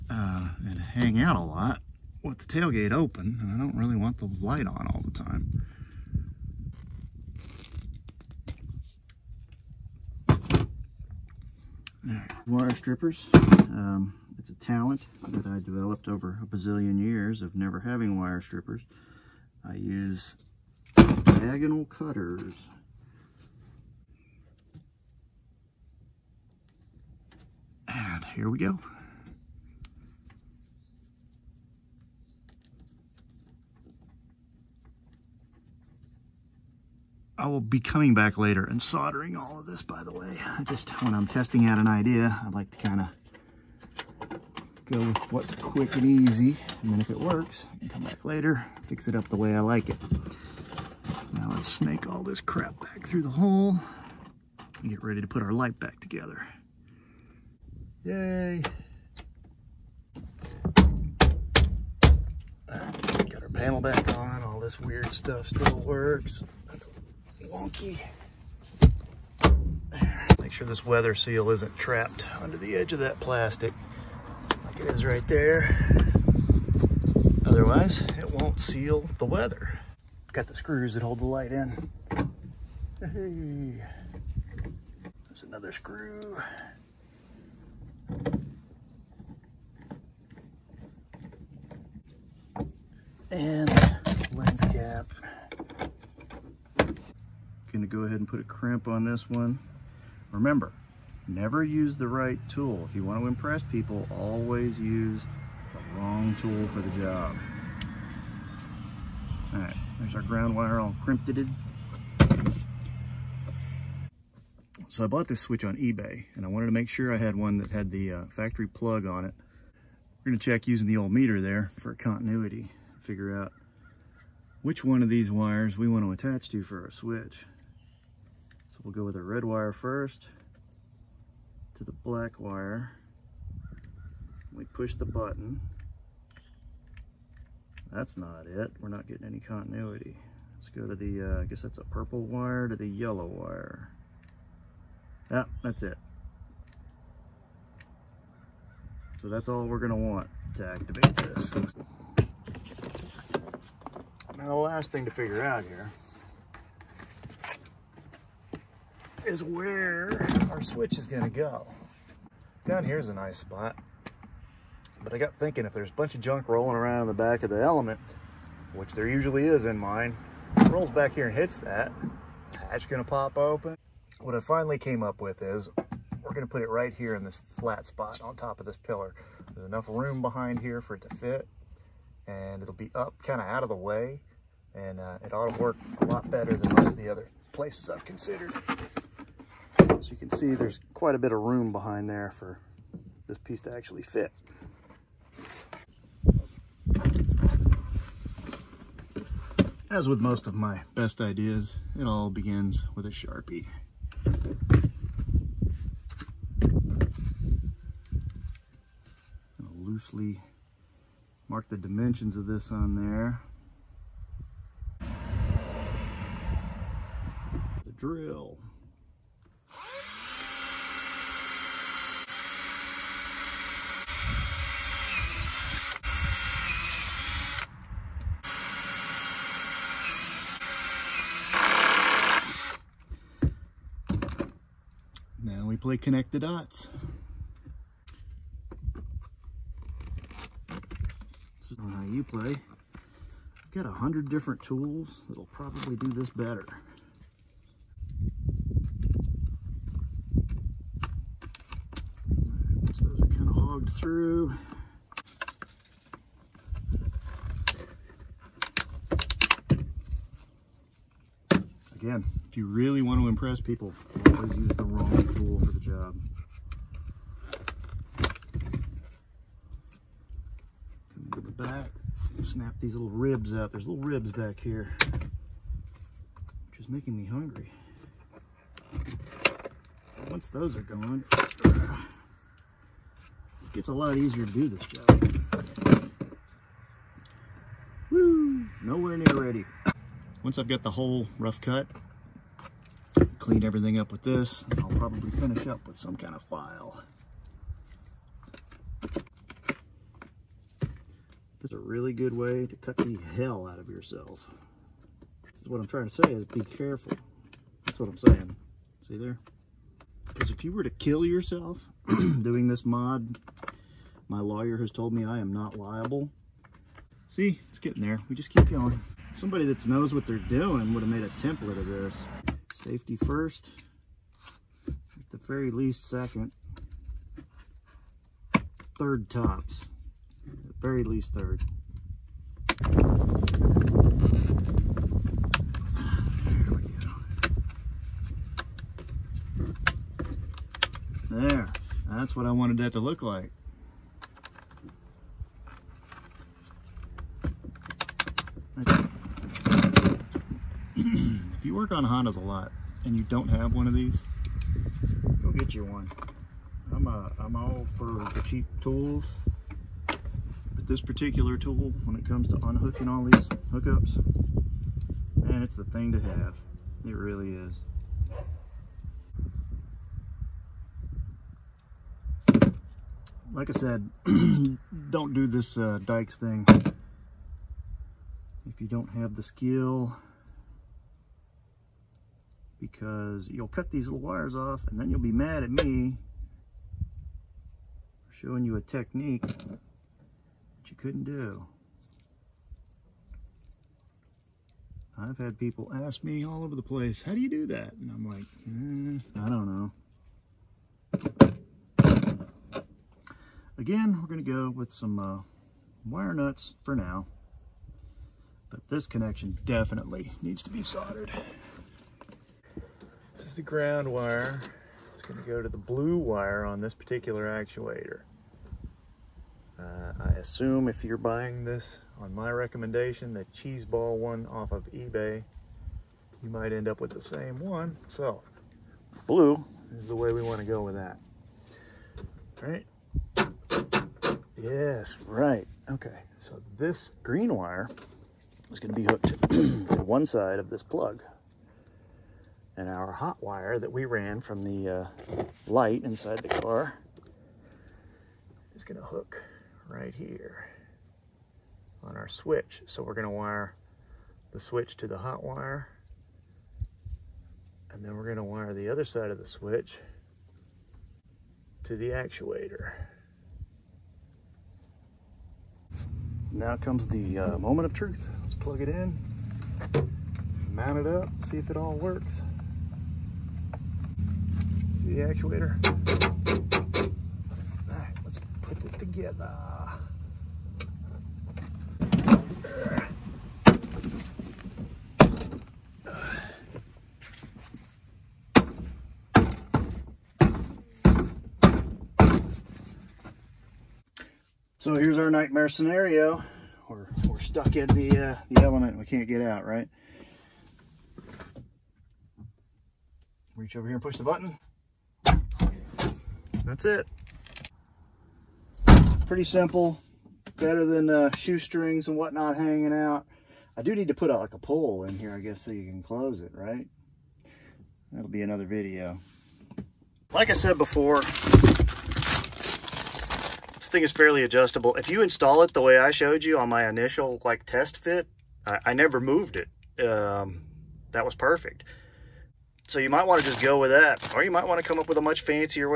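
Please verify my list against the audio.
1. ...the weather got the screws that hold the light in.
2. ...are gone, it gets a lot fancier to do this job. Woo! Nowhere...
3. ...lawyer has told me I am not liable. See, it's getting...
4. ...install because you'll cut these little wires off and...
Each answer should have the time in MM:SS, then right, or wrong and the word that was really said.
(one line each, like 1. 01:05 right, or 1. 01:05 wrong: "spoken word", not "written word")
1. 01:19 right
2. 04:40 wrong: "easier", not "fancier"
3. 05:14 right
4. 06:19 wrong: "skill", not "install".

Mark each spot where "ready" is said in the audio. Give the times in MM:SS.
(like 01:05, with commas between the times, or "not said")
00:55, 04:49.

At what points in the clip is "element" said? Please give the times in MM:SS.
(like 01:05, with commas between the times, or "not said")
02:47, 08:18.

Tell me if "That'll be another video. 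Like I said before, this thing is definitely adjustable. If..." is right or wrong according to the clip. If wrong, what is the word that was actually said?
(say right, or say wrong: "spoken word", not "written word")
wrong: "fairly", not "definitely".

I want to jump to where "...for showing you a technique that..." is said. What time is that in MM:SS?
06:28.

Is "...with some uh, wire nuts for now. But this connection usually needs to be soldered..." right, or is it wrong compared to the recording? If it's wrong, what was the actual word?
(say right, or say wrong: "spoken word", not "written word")
wrong: "definitely", not "usually".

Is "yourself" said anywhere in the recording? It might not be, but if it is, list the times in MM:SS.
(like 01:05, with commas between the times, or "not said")
05:03, 05:11.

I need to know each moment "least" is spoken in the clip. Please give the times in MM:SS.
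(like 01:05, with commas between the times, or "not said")
05:25, 05:31.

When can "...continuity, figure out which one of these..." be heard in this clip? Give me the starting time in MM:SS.
02:01.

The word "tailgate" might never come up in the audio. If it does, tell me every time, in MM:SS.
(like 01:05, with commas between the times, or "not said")
00:02.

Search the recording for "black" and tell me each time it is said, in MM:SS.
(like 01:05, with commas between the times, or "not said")
02:11.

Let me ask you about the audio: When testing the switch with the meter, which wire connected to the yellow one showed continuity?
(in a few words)
Purple wire.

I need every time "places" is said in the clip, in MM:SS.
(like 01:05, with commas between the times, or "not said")
03:07, 06:36.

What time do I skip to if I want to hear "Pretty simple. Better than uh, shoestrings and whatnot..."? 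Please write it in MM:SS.
08:29.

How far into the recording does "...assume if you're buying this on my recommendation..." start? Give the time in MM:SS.
07:00.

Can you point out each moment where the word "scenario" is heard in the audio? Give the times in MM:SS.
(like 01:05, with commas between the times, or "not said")
08:15.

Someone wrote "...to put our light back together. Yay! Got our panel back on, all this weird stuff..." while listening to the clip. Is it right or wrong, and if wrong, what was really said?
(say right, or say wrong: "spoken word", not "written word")
right.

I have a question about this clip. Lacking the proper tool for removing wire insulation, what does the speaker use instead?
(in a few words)
Diagonal cutters.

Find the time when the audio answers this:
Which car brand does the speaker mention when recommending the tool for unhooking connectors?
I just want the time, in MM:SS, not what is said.
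05:52.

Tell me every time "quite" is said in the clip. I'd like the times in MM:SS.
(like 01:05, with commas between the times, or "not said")
03:10.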